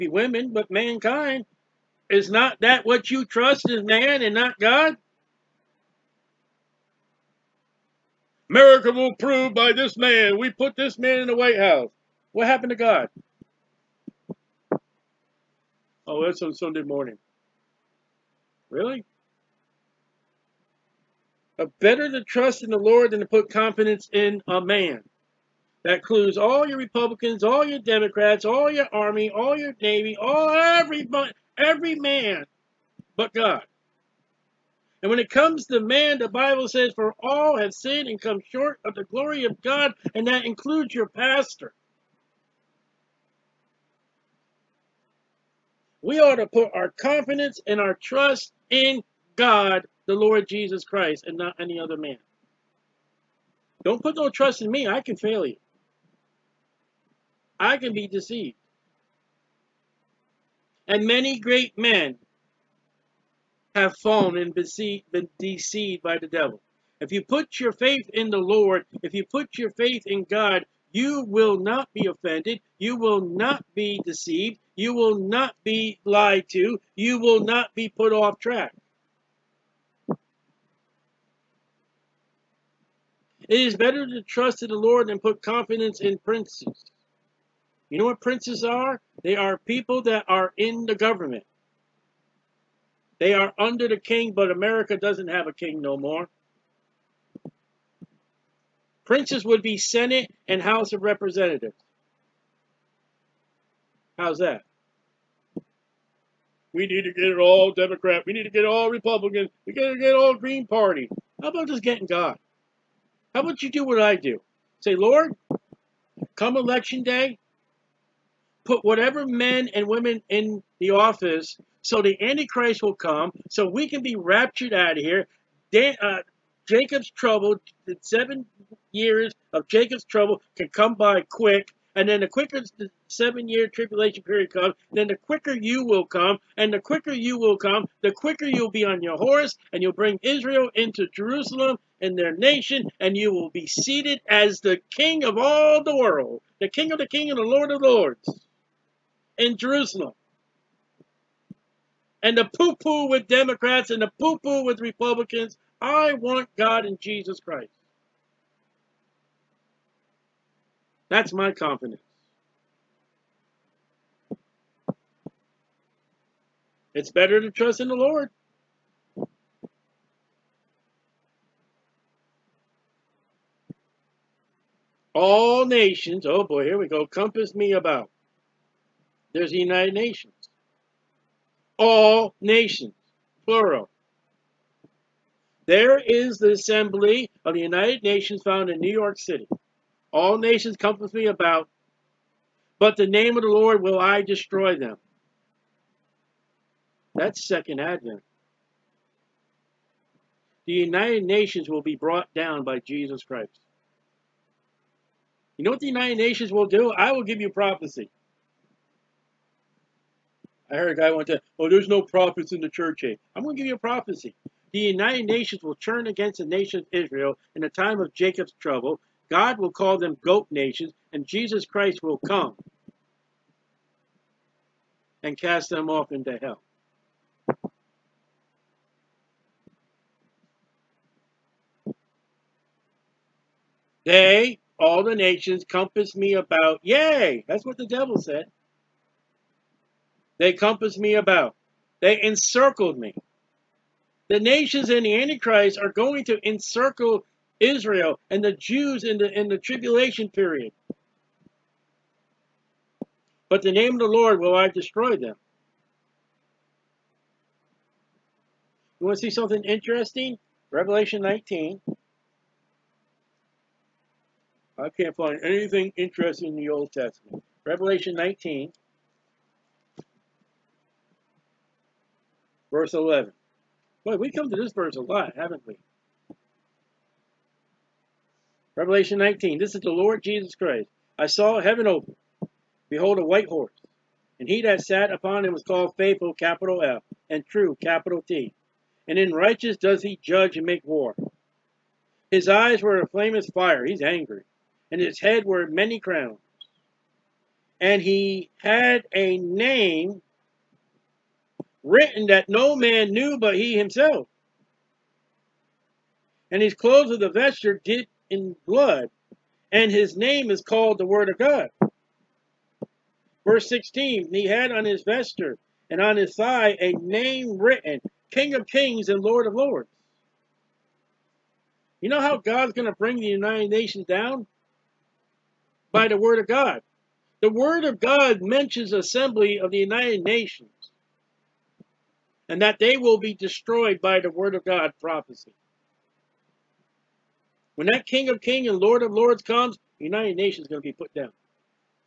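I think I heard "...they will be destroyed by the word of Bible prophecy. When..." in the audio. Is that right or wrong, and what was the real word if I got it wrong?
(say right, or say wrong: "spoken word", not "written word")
wrong: "God", not "Bible".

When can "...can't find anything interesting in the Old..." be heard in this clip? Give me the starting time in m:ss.
4:24.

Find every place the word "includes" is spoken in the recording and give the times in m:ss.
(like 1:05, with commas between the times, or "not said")
0:25, 0:40.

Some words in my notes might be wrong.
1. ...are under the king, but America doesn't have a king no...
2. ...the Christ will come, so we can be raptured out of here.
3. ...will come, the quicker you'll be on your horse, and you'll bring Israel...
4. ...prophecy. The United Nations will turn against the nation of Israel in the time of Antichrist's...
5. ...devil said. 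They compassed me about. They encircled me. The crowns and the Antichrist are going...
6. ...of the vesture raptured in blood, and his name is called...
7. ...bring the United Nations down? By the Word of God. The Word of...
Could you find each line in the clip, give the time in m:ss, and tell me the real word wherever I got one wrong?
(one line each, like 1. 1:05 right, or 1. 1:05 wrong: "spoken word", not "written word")
1. 1:33 right
2. 2:02 wrong: "Antichrist", not "Christ"
3. 2:17 right
4. 3:33 wrong: "Jacob", not "Antichrist"
5. 3:57 wrong: "nations", not "crowns"
6. 5:07 wrong: "dipped", not "raptured"
7. 5:22 right.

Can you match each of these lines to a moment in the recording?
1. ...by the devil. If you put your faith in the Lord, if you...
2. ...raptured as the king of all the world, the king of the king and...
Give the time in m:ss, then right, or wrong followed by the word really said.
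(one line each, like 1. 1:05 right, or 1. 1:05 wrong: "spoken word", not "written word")
1. 1:06 right
2. 2:23 wrong: "seated", not "raptured".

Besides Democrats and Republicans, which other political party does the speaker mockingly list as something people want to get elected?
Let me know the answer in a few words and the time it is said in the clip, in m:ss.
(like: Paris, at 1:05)
Green Party, at 1:50.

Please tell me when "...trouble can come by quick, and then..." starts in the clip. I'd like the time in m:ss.
2:10.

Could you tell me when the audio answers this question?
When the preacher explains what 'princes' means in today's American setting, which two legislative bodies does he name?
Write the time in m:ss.
1:39.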